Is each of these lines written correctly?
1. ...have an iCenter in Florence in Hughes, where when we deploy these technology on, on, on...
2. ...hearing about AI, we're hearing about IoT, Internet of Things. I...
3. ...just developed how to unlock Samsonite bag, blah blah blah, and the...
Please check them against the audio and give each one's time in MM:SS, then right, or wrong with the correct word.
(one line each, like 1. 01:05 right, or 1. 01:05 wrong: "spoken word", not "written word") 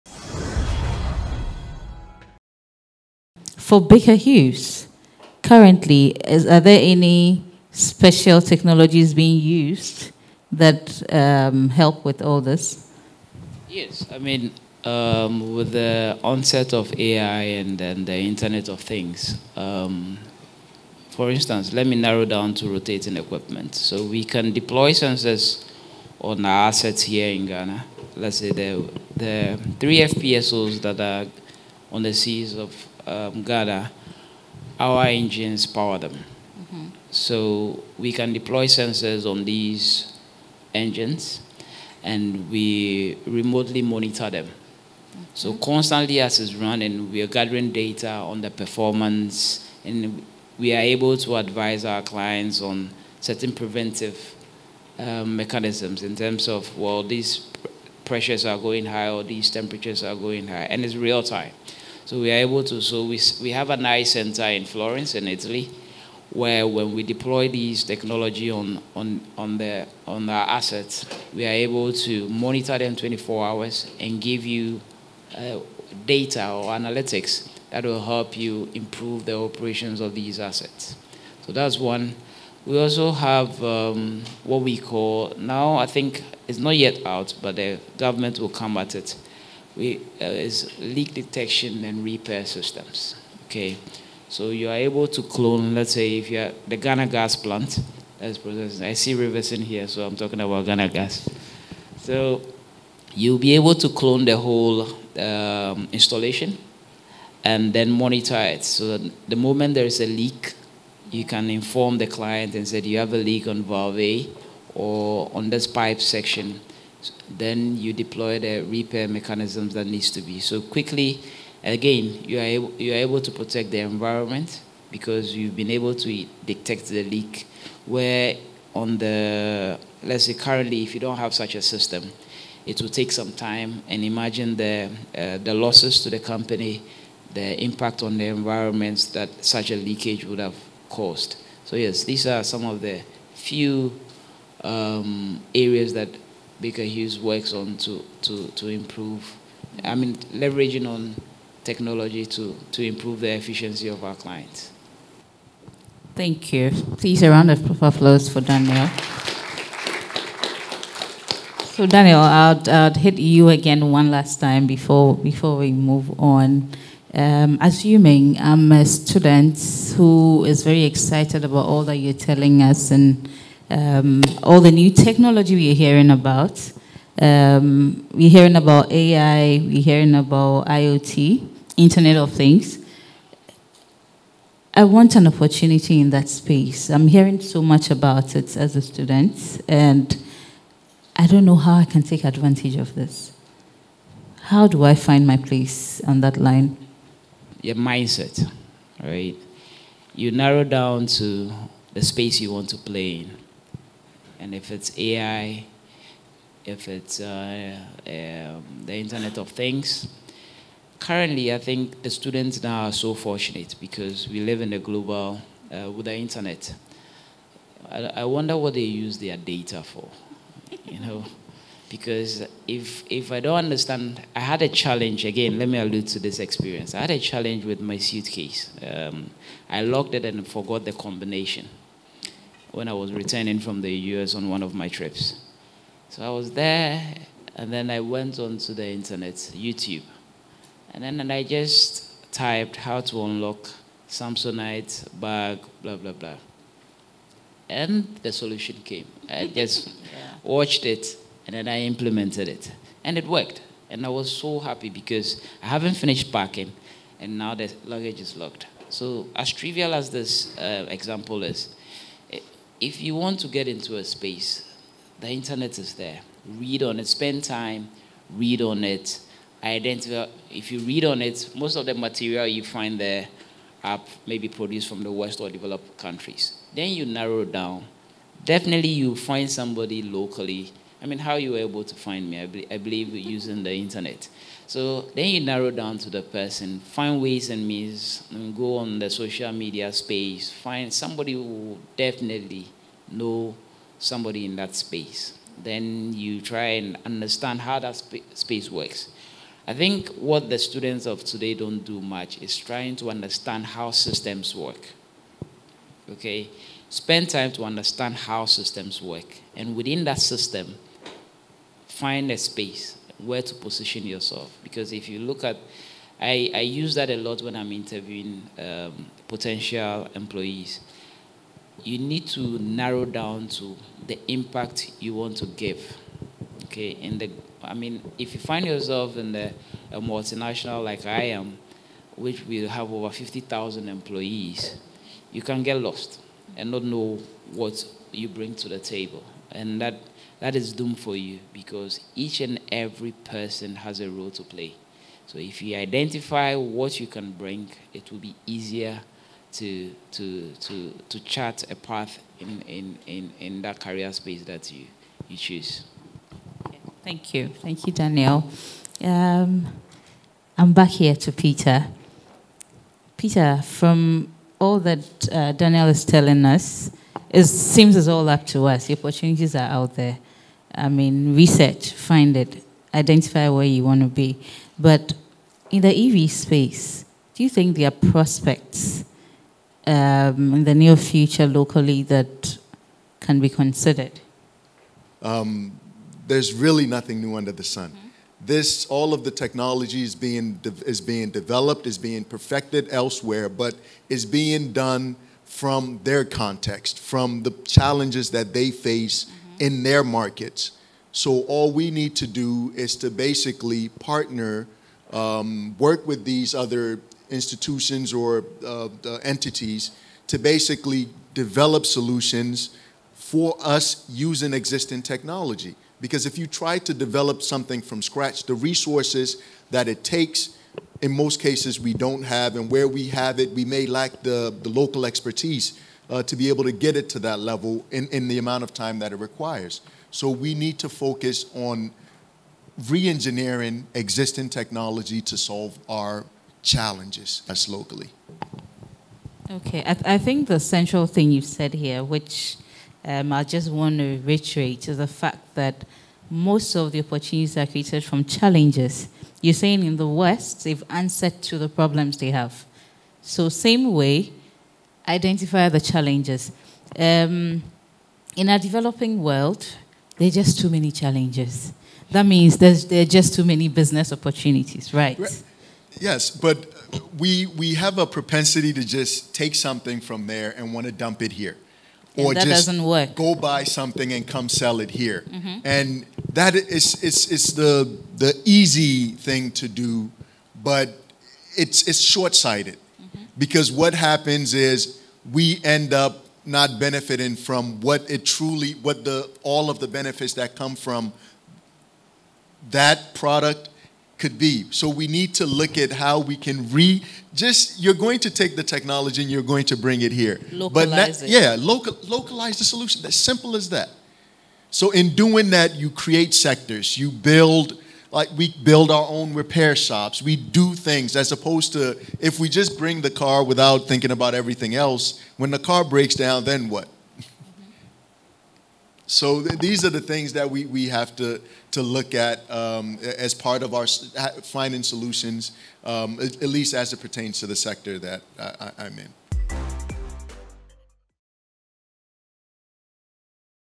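1. 01:03 wrong: "Italy", not "Hughes"
2. 02:58 right
3. 04:01 wrong: "typed", not "developed".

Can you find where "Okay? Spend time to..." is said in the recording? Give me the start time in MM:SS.
05:06.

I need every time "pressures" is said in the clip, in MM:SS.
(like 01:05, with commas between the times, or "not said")
00:58.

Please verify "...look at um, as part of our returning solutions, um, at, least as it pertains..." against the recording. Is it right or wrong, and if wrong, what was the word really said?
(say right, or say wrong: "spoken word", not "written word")
wrong: "finding", not "returning".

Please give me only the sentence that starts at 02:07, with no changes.
Where on the let's say currently, if you don't have such a system, it will take some time.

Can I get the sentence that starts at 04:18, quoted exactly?
So as trivial as this uh, example is, if you want to get into a space, the internet is there.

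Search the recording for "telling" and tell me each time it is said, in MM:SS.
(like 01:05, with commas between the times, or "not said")
02:52, 06:06.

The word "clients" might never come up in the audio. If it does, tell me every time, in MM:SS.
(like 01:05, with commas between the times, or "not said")
00:52, 01:52, 02:34.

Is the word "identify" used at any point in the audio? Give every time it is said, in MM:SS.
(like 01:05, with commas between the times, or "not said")
04:29, 05:45, 06:12, 07:35.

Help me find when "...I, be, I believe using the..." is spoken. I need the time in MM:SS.
04:42.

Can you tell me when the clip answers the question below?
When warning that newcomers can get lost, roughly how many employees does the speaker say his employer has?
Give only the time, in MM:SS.
05:32.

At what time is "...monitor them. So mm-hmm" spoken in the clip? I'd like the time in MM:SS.
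00:43.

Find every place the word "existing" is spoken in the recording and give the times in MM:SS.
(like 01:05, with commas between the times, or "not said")
06:54, 07:13.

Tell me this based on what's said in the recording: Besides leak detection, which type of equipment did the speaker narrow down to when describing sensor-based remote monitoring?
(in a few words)
rotating equipment.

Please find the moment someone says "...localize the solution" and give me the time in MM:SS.
08:22.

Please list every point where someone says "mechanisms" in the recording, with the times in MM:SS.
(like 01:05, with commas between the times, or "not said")
00:55, 01:59.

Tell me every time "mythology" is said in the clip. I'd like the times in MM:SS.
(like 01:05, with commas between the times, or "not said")
not said.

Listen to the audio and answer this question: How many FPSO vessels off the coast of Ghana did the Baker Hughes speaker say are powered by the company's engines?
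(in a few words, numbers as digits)
3.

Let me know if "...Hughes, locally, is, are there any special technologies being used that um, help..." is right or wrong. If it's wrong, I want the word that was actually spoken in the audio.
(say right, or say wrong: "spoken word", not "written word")
wrong: "currently", not "locally".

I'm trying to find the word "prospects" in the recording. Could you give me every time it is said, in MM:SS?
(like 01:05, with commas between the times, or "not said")
06:18.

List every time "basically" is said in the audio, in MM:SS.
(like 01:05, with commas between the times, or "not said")
06:43, 06:50.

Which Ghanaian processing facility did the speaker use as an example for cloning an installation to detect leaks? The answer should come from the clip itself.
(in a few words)
Ghana gas plant.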